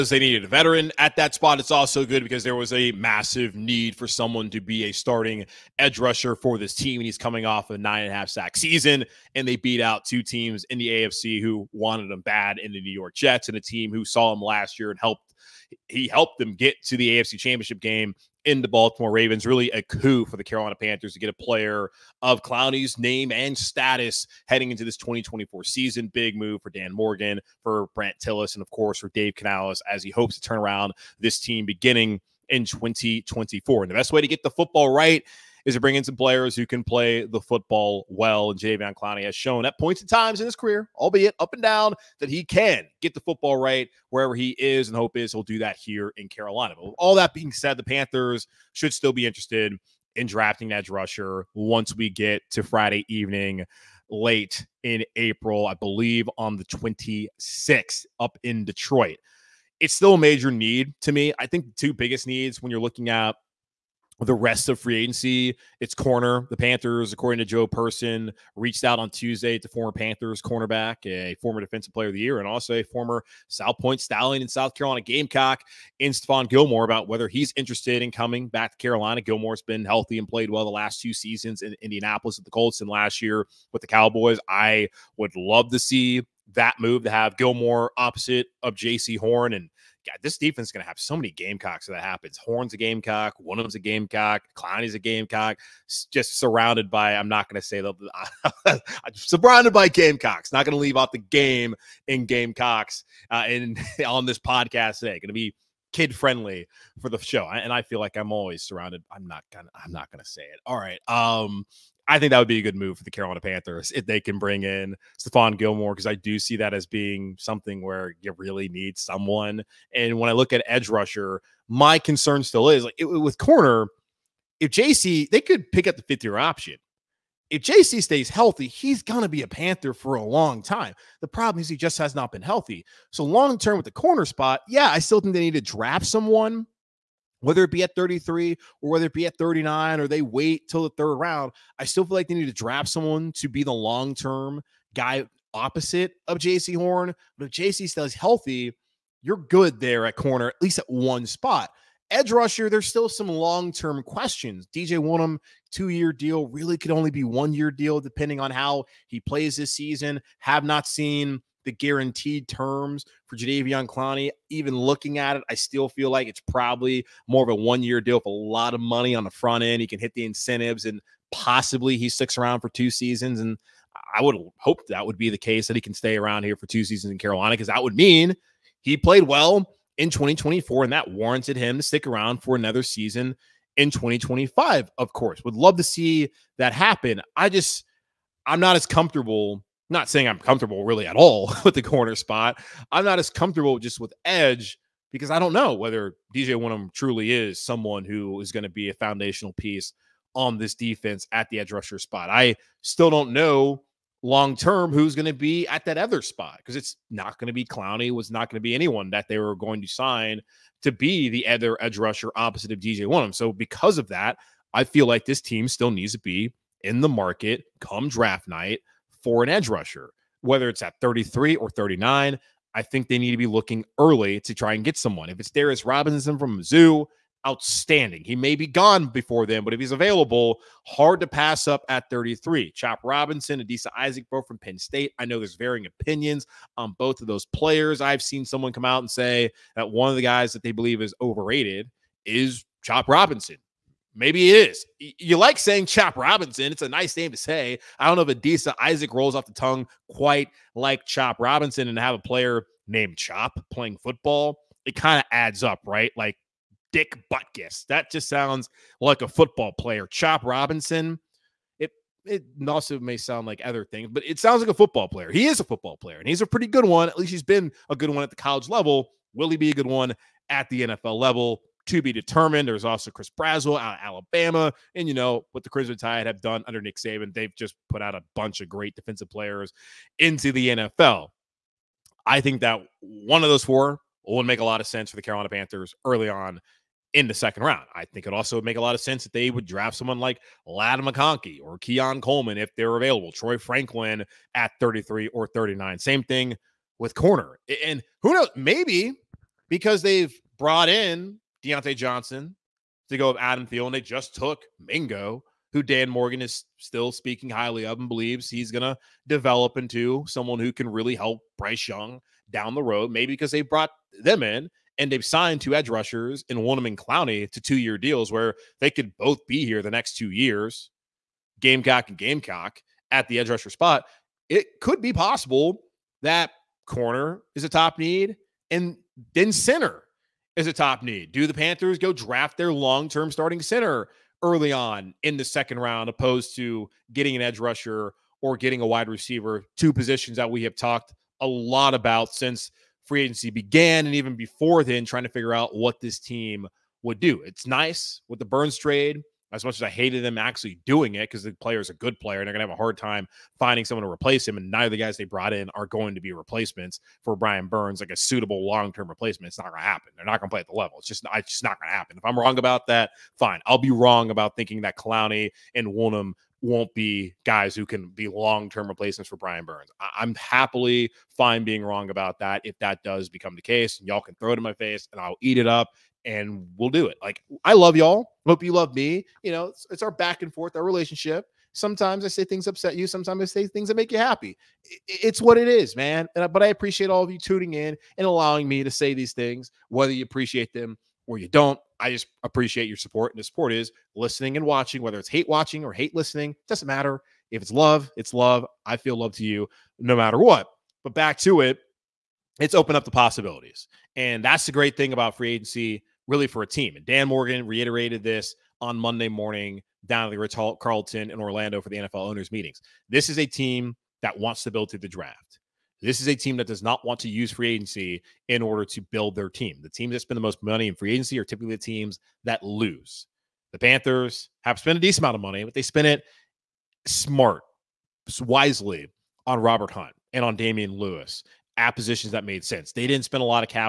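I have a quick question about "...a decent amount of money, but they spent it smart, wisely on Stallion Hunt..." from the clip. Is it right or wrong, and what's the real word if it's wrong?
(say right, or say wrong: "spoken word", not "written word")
wrong: "Robert", not "Stallion".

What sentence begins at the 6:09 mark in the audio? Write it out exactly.
I- am happily fine being wrong about that if that does become the case.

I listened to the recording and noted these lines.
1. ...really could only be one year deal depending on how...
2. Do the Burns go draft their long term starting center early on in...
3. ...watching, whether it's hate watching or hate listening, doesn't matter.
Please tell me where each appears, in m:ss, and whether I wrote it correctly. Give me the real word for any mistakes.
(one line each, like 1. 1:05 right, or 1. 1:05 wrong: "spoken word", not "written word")
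1. 2:36 right
2. 5:31 wrong: "Panthers", not "Burns"
3. 6:34 right.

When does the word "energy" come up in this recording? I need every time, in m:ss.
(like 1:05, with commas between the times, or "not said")
not said.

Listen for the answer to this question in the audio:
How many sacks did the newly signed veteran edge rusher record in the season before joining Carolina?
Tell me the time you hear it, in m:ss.
0:07.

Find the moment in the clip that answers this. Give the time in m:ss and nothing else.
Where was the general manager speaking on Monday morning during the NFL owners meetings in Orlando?
6:50.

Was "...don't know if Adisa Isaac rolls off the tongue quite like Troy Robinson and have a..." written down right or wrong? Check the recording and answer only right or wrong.
wrong.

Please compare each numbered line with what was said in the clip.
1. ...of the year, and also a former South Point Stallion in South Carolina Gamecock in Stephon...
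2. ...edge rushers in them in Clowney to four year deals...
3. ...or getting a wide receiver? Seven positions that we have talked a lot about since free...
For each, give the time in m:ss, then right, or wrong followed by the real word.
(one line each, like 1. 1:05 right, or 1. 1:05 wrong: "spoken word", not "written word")
1. 1:12 right
2. 5:15 wrong: "two", not "four"
3. 5:38 wrong: "Two", not "Seven".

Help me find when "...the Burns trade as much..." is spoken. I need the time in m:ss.
5:48.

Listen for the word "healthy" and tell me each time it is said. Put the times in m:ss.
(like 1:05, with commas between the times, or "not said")
1:19, 2:08, 2:12, 2:28.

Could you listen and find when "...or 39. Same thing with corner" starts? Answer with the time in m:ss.
4:55.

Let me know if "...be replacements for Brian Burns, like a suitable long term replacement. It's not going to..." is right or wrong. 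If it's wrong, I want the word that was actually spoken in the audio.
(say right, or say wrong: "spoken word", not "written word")
right.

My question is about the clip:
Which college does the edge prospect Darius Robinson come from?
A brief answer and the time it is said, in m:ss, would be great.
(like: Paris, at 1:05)
Mizzou, at 3:46.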